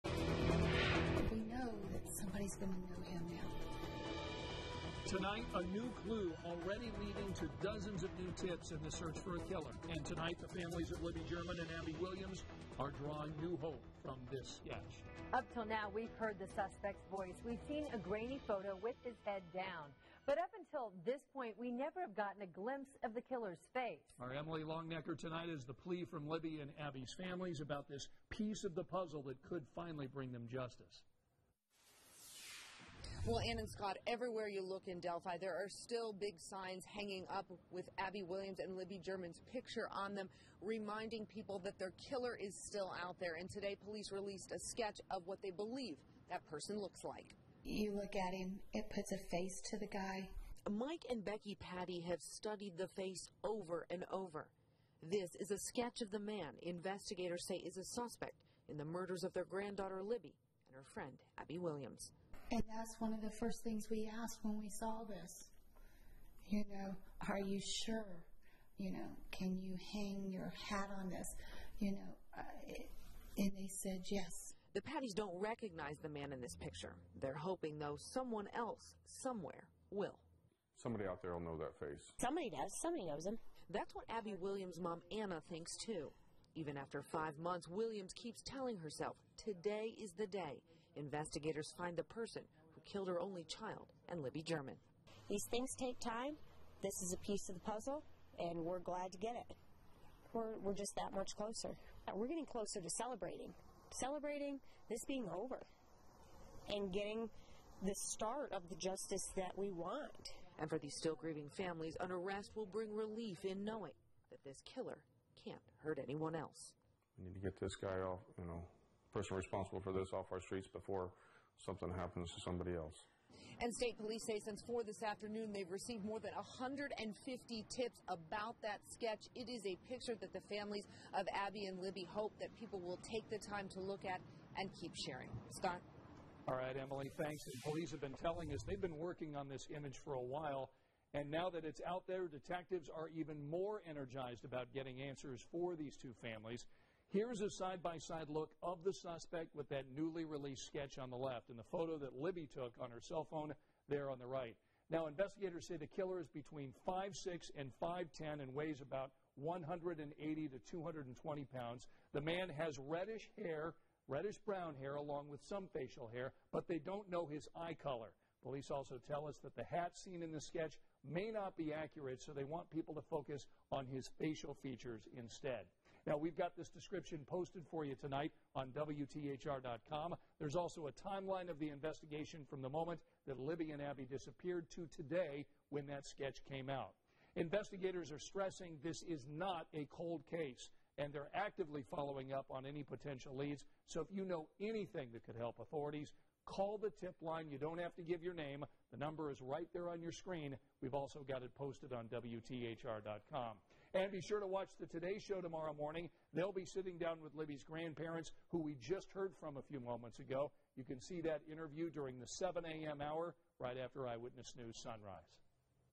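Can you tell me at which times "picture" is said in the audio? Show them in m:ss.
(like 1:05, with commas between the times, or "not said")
0:39, 1:16, 2:09.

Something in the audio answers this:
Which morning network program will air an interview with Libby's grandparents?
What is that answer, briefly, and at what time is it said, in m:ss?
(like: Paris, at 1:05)
The Today Show, at 3:24.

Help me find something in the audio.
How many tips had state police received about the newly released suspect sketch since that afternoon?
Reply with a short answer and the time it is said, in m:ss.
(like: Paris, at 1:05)
More than 150, at 2:06.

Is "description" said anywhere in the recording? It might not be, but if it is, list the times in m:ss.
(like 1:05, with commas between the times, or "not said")
2:56.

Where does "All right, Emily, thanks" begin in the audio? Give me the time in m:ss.
2:16.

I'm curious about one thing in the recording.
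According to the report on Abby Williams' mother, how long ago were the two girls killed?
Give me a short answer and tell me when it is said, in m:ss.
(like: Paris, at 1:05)
5 months, at 1:27.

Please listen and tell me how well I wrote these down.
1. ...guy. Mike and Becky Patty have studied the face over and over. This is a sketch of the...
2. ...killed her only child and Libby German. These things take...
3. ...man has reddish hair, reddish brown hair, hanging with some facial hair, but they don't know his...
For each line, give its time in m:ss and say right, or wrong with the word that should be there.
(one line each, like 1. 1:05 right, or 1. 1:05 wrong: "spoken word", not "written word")
1. 0:49 right
2. 1:32 right
3. 2:42 wrong: "along", not "hanging".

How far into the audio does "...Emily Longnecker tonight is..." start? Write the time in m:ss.
0:24.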